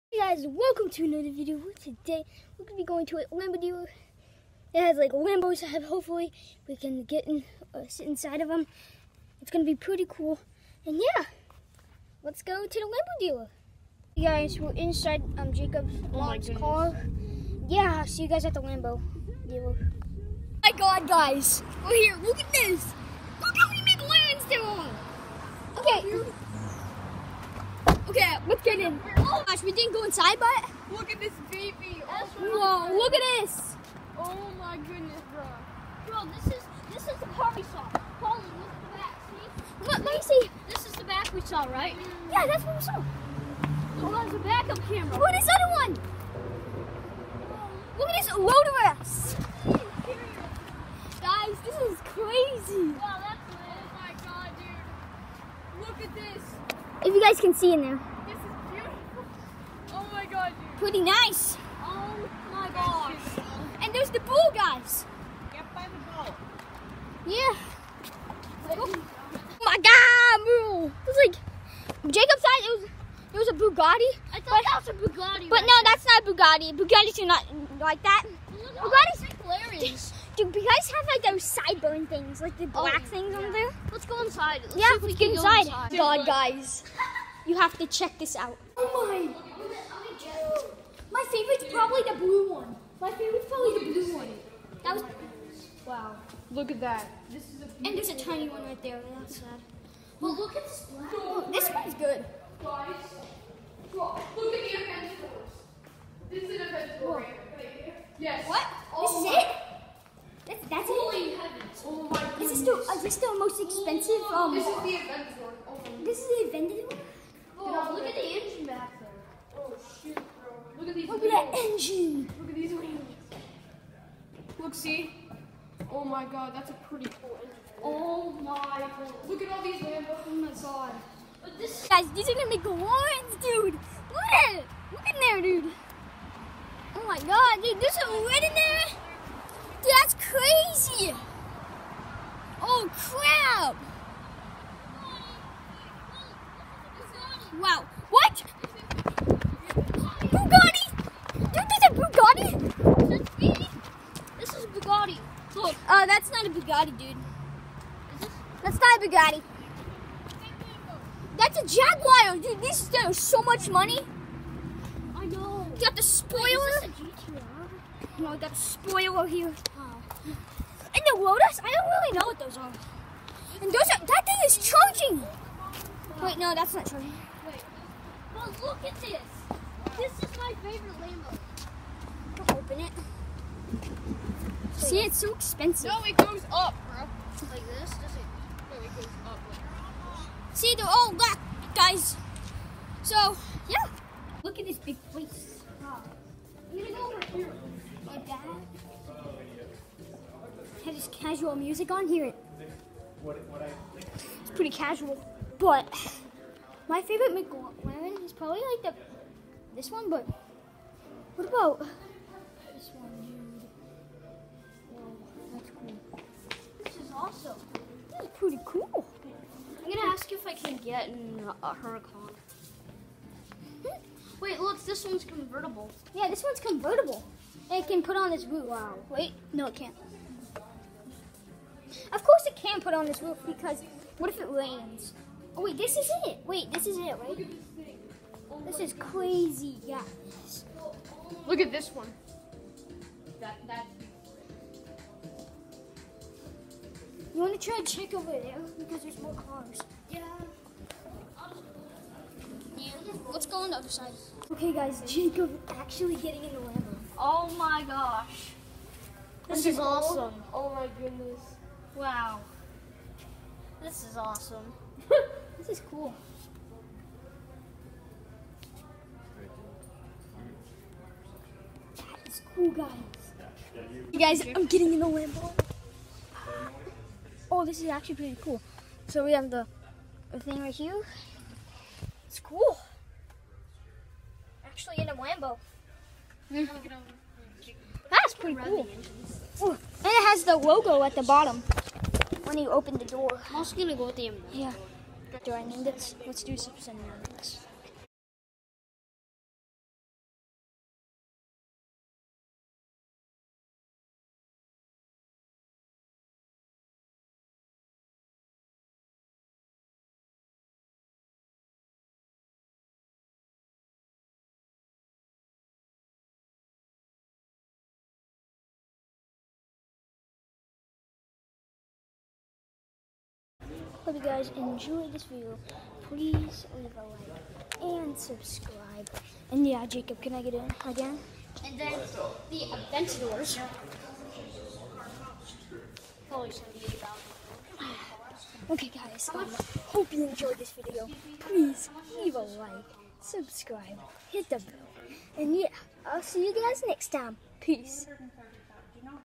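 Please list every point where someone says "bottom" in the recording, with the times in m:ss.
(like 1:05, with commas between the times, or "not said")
4:51.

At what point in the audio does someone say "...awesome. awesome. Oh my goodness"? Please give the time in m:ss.
4:19.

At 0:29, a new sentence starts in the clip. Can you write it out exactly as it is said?
Oh gosh, we didn't go inside, but look at this baby.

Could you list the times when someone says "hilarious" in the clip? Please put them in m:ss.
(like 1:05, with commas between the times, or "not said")
1:19.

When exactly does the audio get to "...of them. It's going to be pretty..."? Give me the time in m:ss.
0:08.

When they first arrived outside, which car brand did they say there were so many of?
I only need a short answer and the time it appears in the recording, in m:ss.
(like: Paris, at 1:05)
McLaren, at 0:23.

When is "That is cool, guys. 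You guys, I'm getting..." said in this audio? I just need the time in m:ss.
4:31.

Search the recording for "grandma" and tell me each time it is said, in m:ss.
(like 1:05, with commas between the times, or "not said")
not said.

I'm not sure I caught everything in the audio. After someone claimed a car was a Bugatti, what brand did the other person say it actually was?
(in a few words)
Jaguar.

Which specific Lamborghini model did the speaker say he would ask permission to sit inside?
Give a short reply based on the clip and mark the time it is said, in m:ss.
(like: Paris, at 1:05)
Huracan, at 3:41.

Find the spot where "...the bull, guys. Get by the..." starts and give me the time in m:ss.
1:04.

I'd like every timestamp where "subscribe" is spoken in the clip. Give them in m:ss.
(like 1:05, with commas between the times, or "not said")
5:28, 5:43.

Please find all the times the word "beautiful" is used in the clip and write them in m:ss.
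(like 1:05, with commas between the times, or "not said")
0:58.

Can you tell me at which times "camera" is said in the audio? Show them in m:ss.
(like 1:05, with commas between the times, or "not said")
0:44.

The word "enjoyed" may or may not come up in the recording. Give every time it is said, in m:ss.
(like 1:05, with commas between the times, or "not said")
5:24, 5:40.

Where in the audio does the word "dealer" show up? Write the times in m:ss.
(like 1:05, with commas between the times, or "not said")
0:03, 0:13, 0:19.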